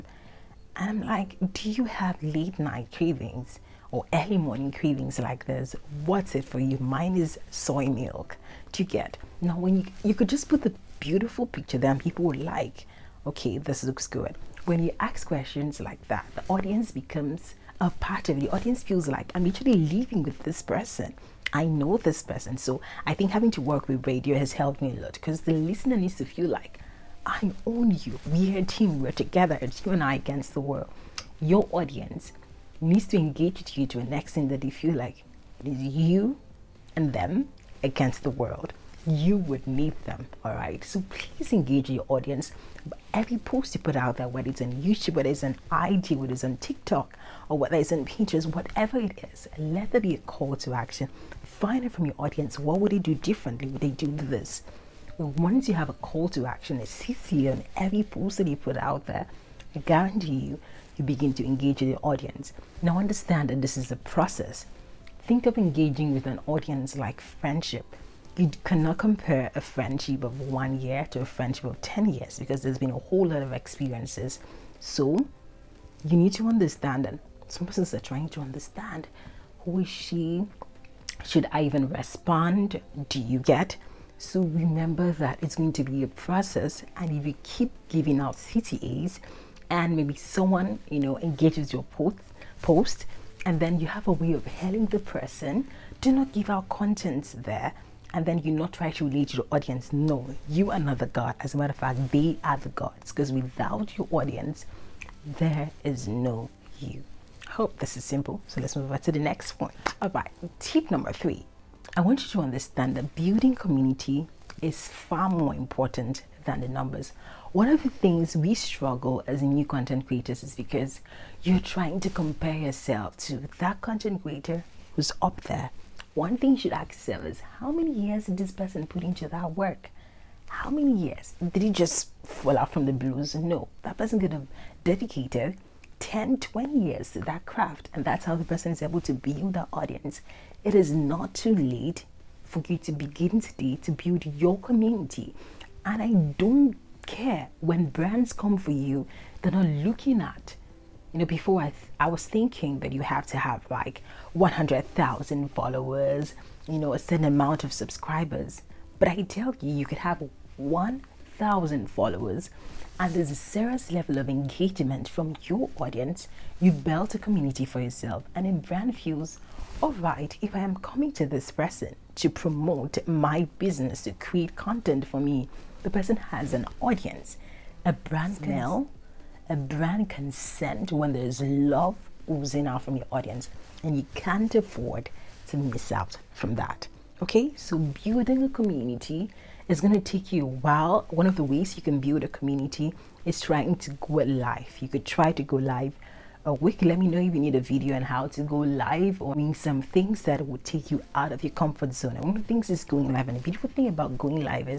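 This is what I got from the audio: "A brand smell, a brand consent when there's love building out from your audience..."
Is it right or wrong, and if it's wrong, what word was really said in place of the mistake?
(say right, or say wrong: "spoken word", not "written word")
wrong: "oozing", not "building".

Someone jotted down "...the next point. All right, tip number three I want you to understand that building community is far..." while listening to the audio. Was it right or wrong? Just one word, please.
right.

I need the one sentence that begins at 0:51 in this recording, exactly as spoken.
Find it from your audience what would they do differently?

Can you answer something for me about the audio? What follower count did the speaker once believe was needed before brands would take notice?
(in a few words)
100,000.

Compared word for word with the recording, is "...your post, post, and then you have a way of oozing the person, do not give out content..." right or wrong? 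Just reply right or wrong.
wrong.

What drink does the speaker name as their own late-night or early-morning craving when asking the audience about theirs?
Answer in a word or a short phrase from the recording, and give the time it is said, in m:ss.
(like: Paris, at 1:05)
Soy milk, at 0:07.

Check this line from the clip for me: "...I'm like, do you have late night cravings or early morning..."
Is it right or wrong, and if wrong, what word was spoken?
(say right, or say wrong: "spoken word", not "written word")
right.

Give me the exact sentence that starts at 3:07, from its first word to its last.
Okay, so building a community is going to take you a while.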